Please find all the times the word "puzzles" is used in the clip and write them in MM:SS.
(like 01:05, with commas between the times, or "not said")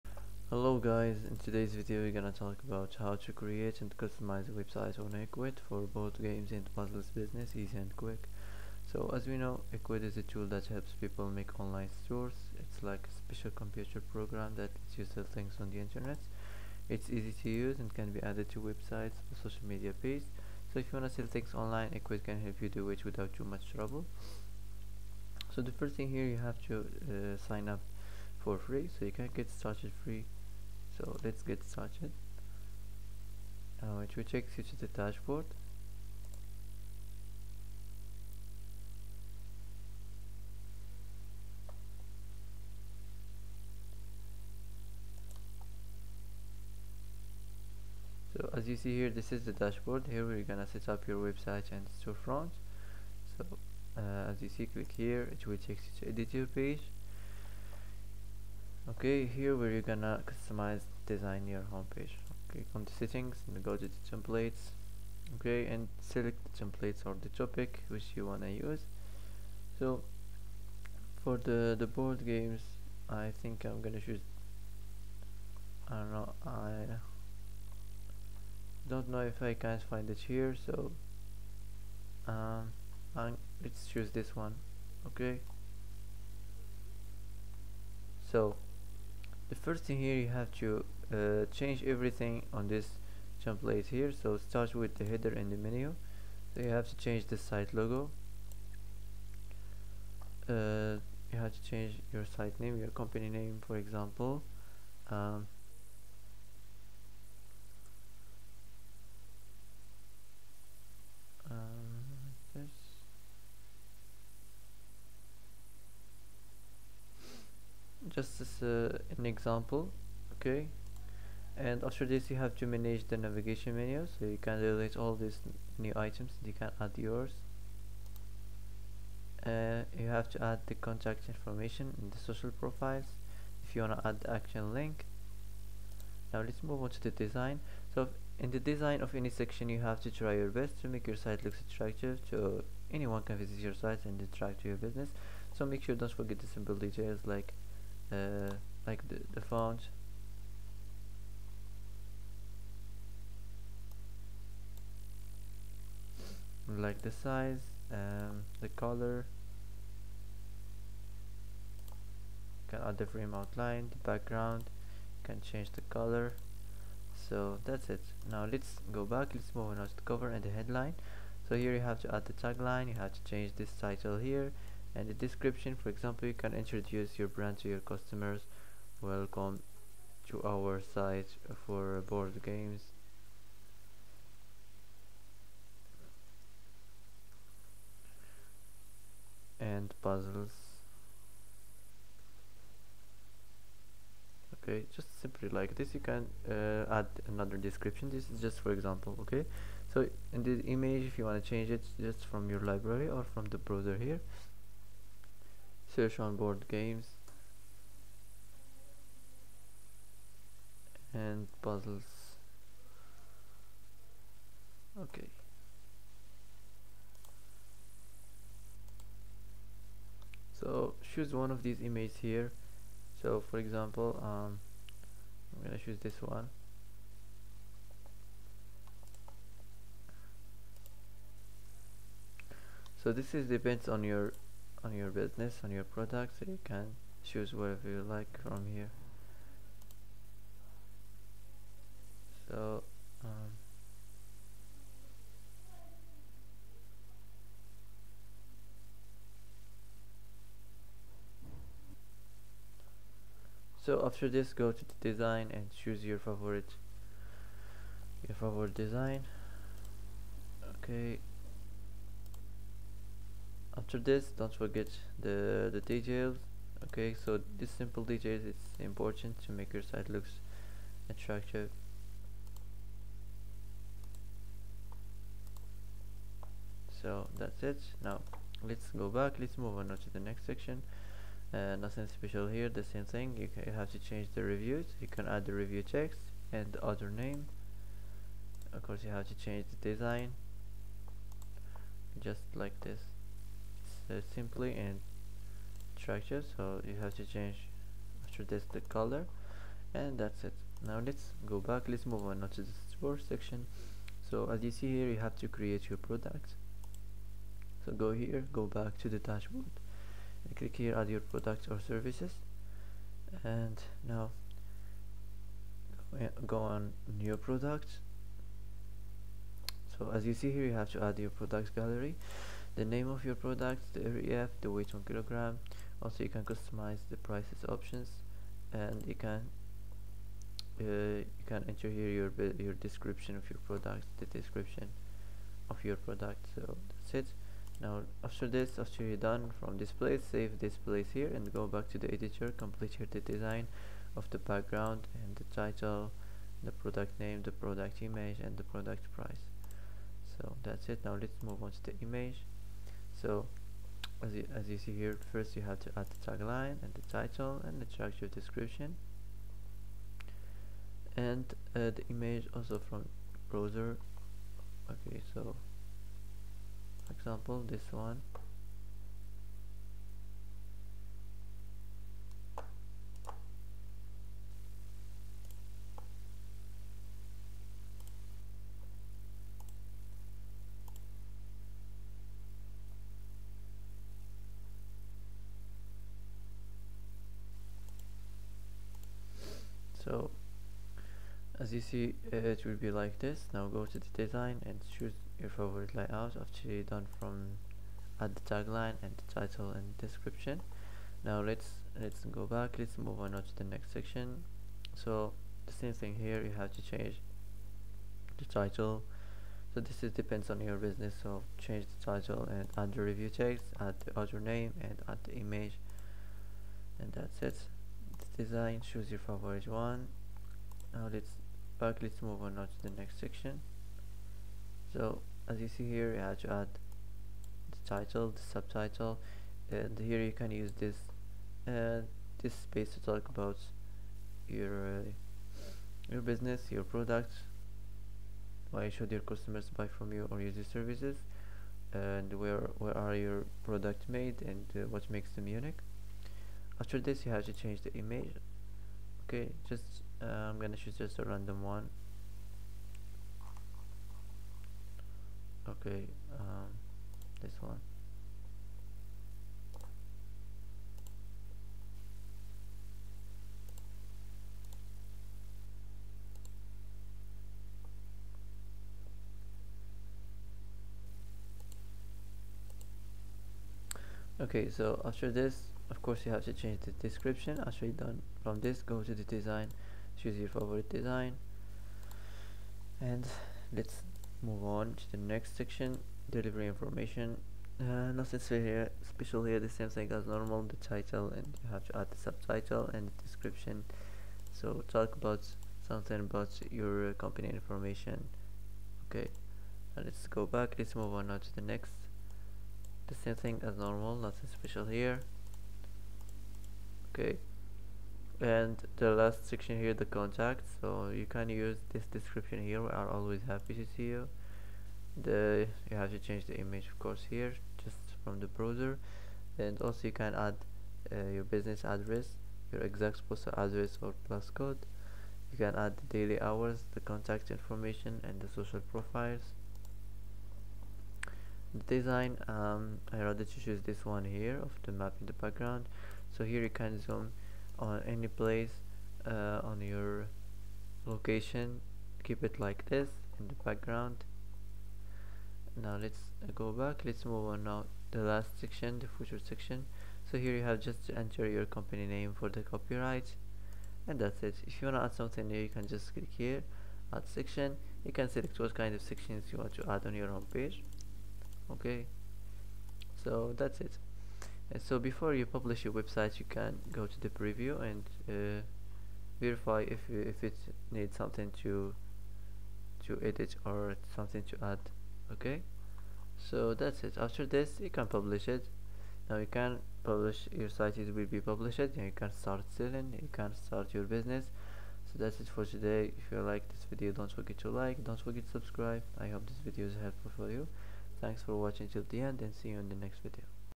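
00:06, 03:10, 03:31.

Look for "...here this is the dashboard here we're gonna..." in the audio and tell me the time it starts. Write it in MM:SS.
00:48.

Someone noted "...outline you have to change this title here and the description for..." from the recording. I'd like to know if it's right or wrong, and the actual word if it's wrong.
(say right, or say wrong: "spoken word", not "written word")
wrong: "tagline", not "outline".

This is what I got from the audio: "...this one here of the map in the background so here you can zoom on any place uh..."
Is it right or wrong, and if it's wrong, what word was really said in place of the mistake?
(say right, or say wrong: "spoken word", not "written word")
right.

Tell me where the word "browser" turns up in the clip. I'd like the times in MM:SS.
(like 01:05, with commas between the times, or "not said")
03:23, 06:03, 08:38.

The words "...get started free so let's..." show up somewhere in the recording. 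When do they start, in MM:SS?
00:29.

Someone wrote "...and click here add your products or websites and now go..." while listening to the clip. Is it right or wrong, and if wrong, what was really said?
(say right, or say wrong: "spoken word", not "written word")
wrong: "services", not "websites".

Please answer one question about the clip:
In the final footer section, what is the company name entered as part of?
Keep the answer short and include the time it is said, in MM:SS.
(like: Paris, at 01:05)
the copyright, at 09:12.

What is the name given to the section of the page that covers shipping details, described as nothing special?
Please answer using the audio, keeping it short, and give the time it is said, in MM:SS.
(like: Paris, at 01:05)
delivery information, at 08:06.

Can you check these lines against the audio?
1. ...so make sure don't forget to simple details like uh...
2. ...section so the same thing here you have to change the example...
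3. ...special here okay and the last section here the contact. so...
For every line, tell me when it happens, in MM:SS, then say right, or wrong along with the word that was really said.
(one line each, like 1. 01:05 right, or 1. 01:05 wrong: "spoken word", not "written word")
1. 02:25 right
2. 06:43 wrong: "title", not "example"
3. 08:24 right.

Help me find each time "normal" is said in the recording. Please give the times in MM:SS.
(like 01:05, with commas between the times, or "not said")
08:10, 08:23.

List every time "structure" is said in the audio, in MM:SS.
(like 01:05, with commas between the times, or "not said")
04:55, 05:57.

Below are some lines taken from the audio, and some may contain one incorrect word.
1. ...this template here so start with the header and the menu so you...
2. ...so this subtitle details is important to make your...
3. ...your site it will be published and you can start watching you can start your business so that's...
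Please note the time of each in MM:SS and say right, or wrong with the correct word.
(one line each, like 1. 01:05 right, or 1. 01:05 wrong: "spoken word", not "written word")
1. 01:32 right
2. 04:27 wrong: "simple", not "subtitle"
3. 09:40 wrong: "selling", not "watching".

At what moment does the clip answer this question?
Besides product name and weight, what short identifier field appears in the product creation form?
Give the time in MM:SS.
05:23.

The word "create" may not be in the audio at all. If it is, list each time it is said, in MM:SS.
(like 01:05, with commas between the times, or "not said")
00:03, 05:05.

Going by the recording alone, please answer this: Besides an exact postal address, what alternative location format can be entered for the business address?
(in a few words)
plus code.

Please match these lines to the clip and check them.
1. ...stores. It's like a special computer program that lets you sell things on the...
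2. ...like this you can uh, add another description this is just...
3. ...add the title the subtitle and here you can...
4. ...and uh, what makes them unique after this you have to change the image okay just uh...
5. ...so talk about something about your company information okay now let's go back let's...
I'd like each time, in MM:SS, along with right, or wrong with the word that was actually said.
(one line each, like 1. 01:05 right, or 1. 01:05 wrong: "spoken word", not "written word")
1. 00:12 right
2. 03:15 right
3. 07:06 right
4. 07:24 right
5. 08:14 right.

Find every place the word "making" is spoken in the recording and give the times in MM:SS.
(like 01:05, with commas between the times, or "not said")
not said.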